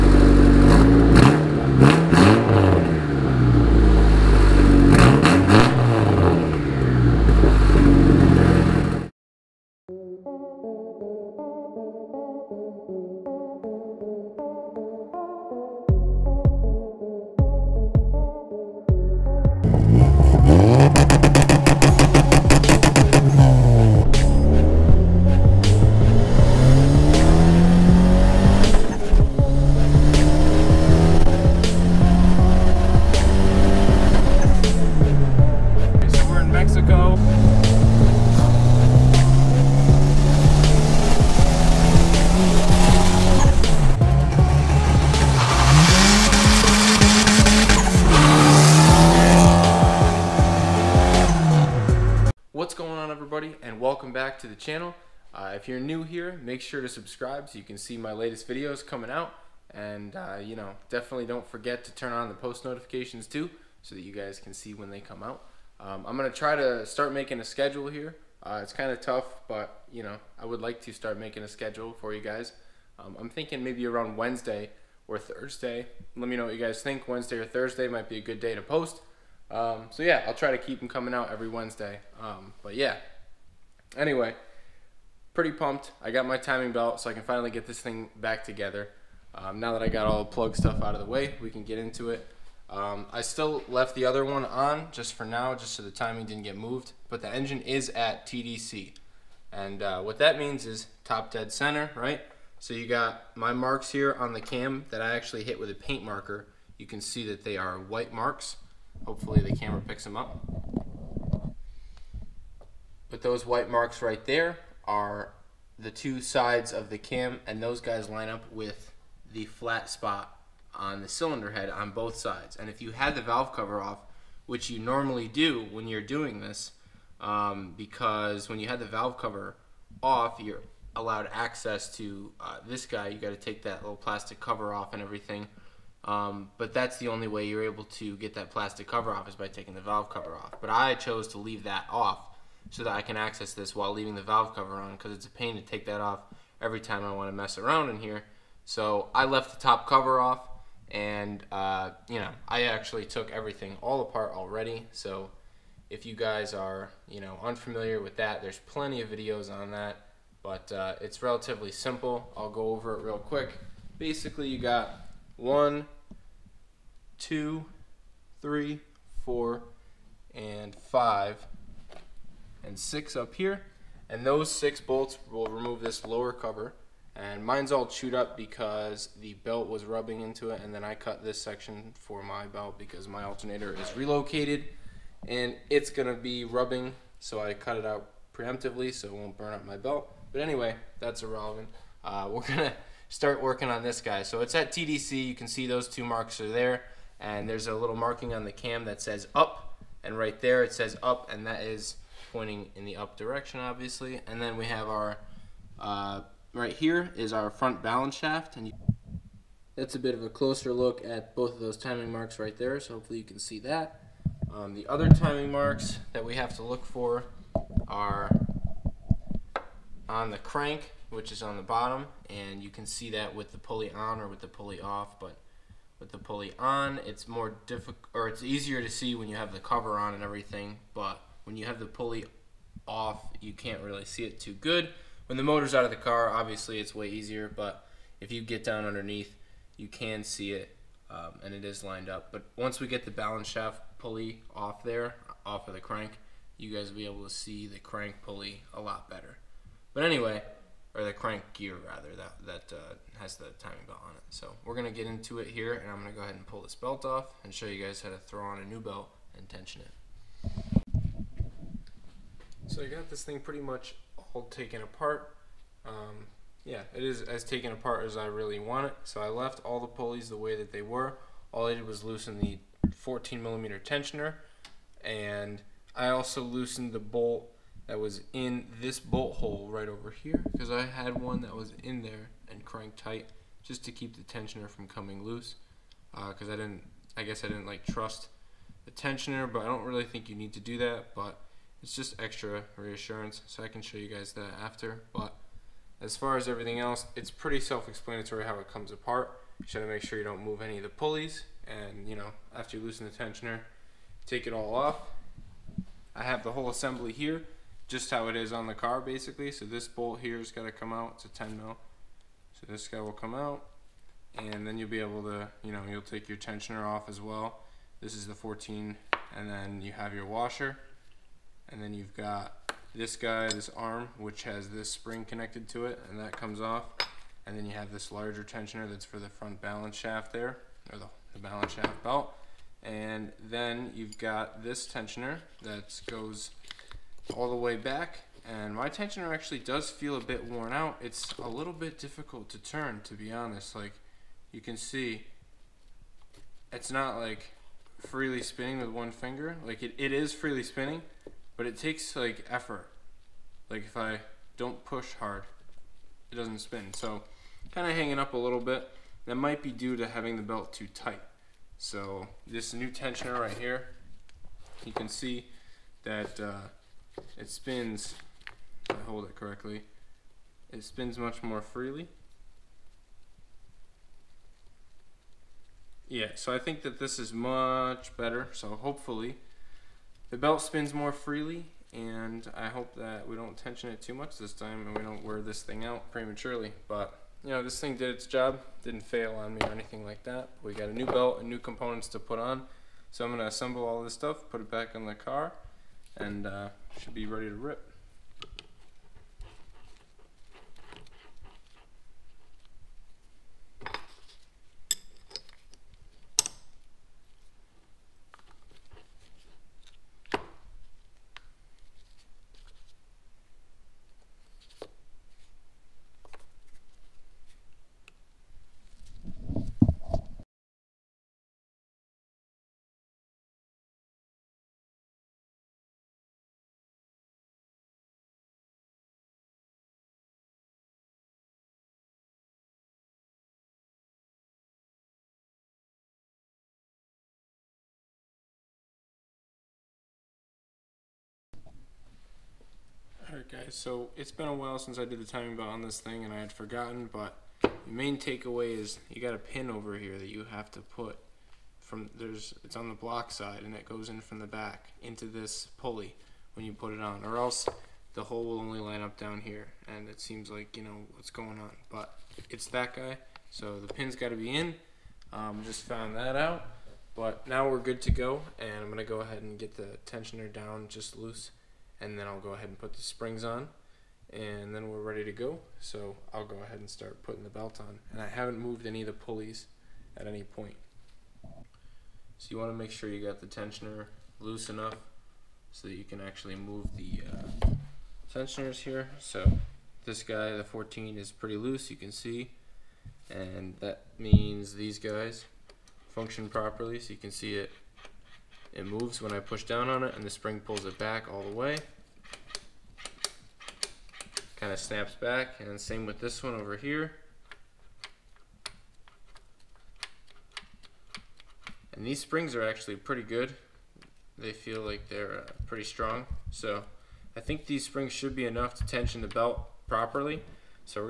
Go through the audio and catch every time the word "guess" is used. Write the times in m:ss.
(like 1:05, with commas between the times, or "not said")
4:47.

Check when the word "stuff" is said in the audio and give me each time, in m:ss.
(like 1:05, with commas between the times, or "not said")
1:30, 6:34.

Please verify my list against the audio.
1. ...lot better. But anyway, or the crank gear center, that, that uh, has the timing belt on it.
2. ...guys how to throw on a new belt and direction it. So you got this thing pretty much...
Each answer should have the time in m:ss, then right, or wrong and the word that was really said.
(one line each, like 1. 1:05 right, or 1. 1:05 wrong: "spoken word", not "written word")
1. 4:08 wrong: "rather", not "center"
2. 4:17 wrong: "tension", not "direction".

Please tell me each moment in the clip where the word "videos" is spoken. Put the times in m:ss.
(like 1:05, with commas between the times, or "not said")
0:58, 2:39.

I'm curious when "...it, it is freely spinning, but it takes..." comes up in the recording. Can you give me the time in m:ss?
5:49.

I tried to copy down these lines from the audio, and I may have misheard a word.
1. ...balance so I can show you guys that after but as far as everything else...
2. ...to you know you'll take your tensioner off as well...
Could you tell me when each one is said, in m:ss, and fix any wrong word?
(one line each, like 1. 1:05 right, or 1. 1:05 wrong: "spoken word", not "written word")
1. 4:52 wrong: "reassurance", not "balance"
2. 5:15 right.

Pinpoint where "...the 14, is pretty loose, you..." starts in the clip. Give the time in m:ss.
8:10.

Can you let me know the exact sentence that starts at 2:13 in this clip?
You got to take that little plastic cover off and everything.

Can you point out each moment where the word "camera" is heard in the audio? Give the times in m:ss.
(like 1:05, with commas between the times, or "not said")
1:49.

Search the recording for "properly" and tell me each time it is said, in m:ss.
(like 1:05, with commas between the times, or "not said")
8:16, 8:39.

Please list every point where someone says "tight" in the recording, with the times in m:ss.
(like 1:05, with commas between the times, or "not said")
4:42, 6:00.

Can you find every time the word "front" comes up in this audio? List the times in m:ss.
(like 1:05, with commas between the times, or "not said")
3:27, 5:29.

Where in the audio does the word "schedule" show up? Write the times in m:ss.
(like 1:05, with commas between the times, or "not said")
1:07, 1:11.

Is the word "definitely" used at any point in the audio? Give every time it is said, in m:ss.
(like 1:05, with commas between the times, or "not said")
1:00.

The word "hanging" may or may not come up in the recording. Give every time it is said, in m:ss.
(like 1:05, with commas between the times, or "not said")
5:57.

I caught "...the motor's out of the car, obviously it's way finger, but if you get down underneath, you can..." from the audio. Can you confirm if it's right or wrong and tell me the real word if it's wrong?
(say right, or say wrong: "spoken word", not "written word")
wrong: "easier", not "finger".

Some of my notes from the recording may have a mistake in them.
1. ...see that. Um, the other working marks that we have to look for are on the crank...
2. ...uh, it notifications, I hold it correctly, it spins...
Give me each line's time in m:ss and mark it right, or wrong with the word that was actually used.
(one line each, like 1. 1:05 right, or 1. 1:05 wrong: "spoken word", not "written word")
1. 3:33 wrong: "timing", not "working"
2. 6:06 wrong: "spins", not "notifications".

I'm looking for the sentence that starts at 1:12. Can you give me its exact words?
Um, I'm thinking maybe around Wednesday or Thursday.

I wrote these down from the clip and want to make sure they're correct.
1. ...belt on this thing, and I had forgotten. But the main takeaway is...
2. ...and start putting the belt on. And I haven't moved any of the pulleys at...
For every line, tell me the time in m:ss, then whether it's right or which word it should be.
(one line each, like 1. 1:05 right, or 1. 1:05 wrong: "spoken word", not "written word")
1. 7:25 right
2. 7:56 right.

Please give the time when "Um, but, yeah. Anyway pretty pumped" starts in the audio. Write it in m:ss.
1:22.